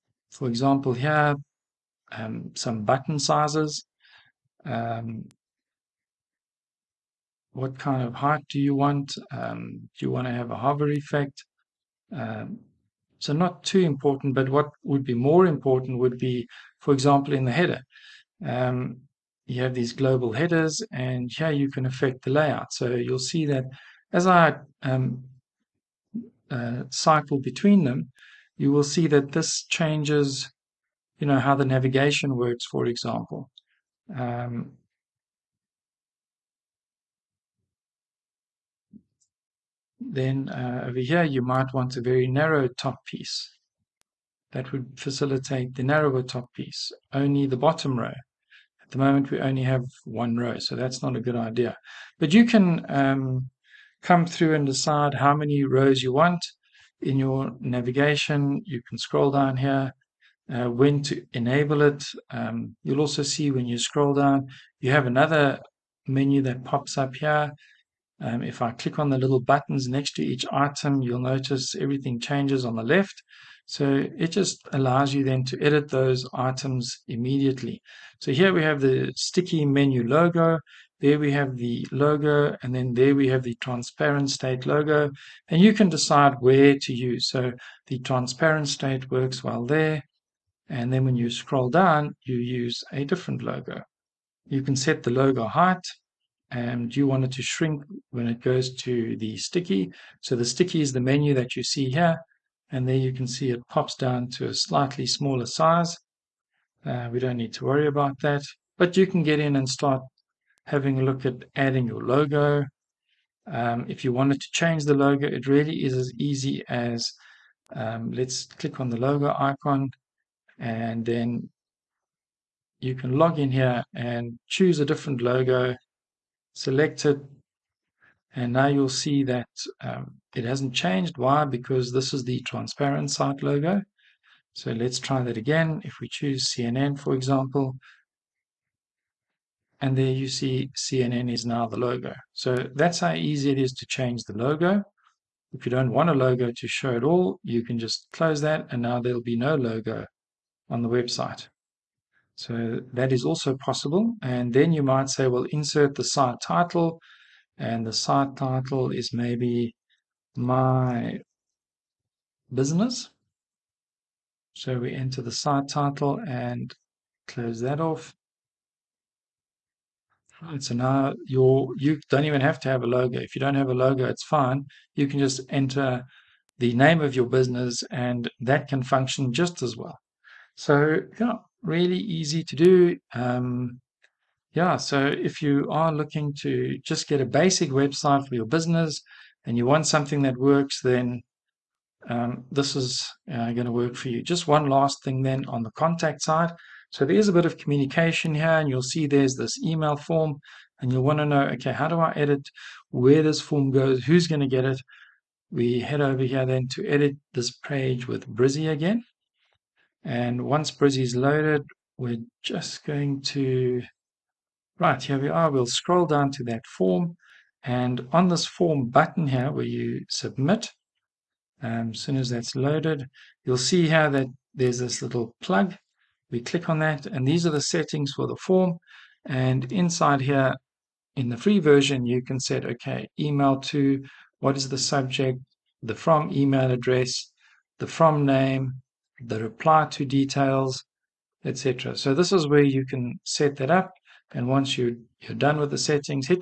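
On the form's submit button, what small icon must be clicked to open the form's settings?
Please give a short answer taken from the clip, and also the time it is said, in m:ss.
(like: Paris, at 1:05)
plug, at 3:45.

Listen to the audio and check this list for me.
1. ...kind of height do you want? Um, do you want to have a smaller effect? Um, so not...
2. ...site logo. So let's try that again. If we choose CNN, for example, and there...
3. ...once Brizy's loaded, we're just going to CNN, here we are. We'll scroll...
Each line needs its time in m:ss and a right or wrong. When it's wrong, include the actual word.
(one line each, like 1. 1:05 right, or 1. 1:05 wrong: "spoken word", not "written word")
1. 0:07 wrong: "hover", not "smaller"
2. 2:13 right
3. 3:30 wrong: "Right", not "CNN".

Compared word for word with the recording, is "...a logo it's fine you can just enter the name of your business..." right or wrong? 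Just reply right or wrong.
right.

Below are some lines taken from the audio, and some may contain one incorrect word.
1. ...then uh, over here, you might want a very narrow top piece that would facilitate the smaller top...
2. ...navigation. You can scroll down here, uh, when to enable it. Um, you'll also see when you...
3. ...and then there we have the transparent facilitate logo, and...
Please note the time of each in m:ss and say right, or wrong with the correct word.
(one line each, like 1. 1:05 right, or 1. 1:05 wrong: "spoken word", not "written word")
1. 0:39 wrong: "narrower", not "smaller"
2. 0:57 right
3. 1:22 wrong: "state", not "facilitate".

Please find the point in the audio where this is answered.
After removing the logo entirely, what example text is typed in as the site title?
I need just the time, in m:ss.
2:40.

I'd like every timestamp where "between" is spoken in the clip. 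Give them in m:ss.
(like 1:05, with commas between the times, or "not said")
0:27.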